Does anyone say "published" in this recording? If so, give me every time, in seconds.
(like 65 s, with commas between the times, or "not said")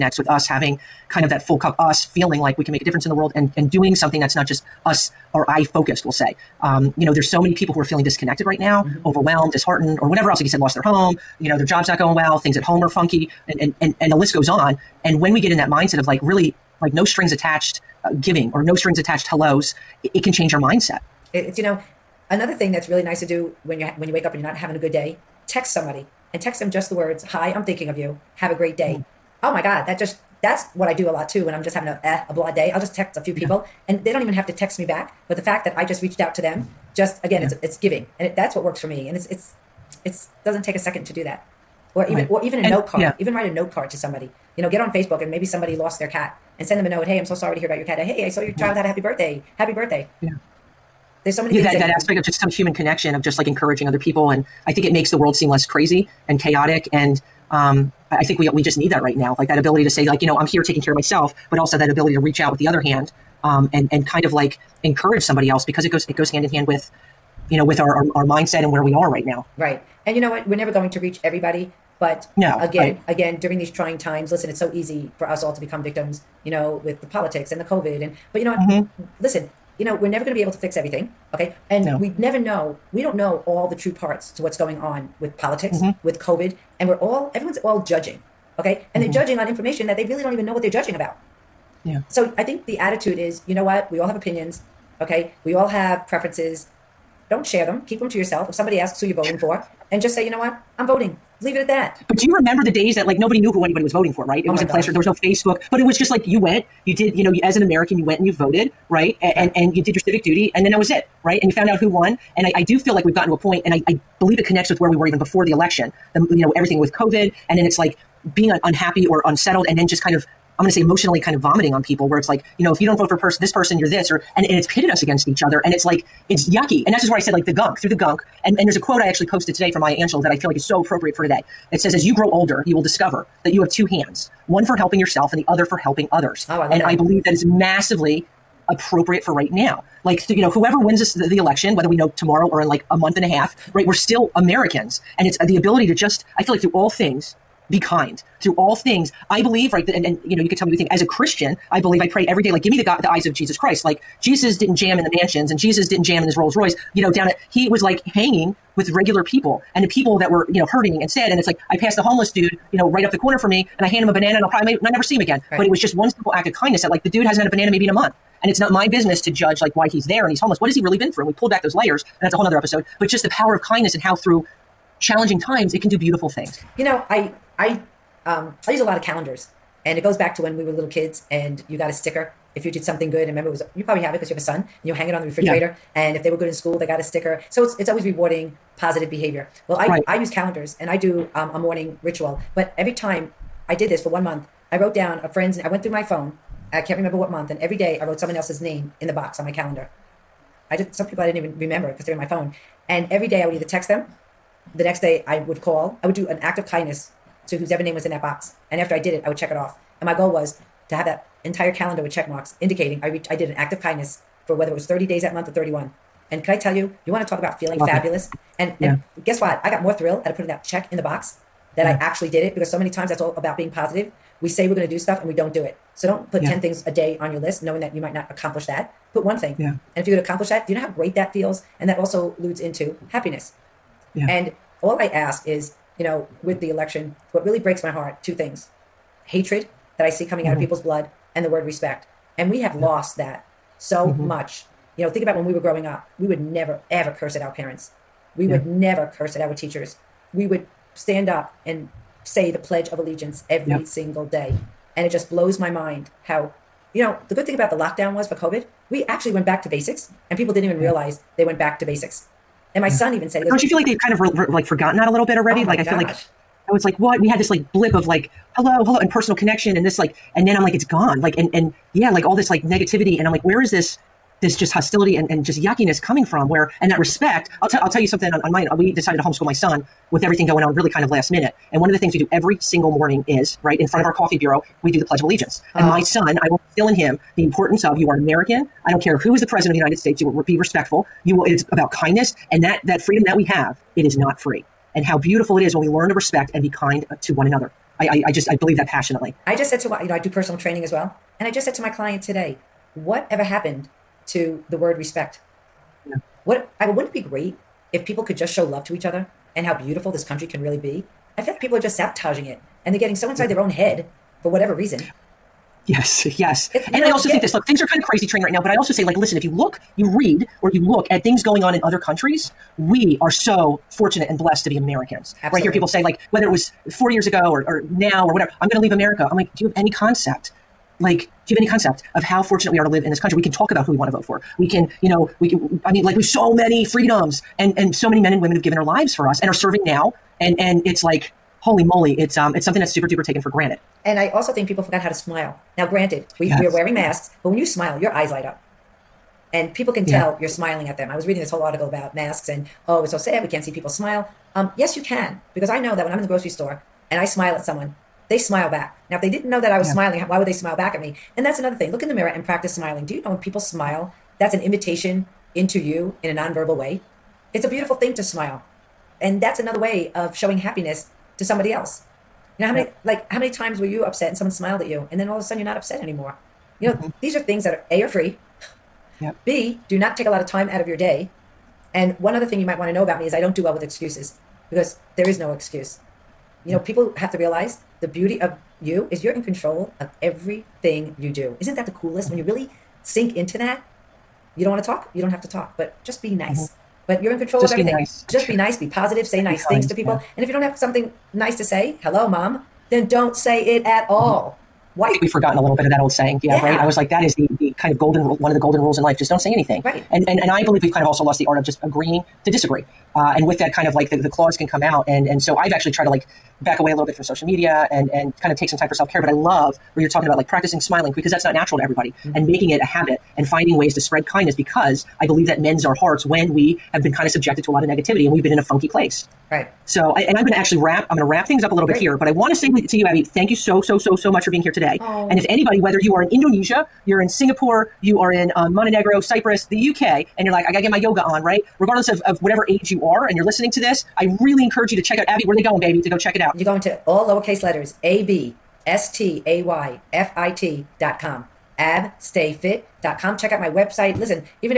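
not said.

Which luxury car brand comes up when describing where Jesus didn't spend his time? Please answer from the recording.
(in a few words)
Rolls Royce.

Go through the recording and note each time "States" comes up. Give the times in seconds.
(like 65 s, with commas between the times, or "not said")
289 s.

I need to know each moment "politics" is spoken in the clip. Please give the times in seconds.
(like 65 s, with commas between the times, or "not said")
77 s, 85 s.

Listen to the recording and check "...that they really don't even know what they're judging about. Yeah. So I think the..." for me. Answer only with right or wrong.
right.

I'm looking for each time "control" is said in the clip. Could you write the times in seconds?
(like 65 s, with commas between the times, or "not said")
389 s, 397 s.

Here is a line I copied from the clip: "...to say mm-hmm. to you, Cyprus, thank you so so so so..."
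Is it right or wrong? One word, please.
wrong.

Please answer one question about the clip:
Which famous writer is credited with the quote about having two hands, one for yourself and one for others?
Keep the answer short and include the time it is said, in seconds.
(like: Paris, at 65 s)
Maya Angelou, at 129 s.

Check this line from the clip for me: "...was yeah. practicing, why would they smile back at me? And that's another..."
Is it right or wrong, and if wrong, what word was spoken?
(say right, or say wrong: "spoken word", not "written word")
wrong: "smiling", not "practicing".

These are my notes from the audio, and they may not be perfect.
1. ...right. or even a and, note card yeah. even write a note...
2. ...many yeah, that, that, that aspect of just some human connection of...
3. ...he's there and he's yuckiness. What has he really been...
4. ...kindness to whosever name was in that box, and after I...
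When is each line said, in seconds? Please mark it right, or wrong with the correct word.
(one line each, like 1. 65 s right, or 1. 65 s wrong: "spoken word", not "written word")
1. 42 s right
2. 51 s right
3. 169 s wrong: "homeless", not "yuckiness"
4. 206 s right.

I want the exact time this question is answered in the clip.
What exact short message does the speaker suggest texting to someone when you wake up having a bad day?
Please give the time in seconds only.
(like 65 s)
27 s.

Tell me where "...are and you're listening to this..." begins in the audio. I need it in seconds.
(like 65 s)
443 s.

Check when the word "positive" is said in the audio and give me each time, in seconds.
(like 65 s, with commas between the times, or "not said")
188 s, 223 s, 398 s.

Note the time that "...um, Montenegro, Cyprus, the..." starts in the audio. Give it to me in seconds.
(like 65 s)
438 s.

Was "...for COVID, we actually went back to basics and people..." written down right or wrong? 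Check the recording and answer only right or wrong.
right.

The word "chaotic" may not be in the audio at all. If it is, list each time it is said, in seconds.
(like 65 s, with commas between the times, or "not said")
56 s.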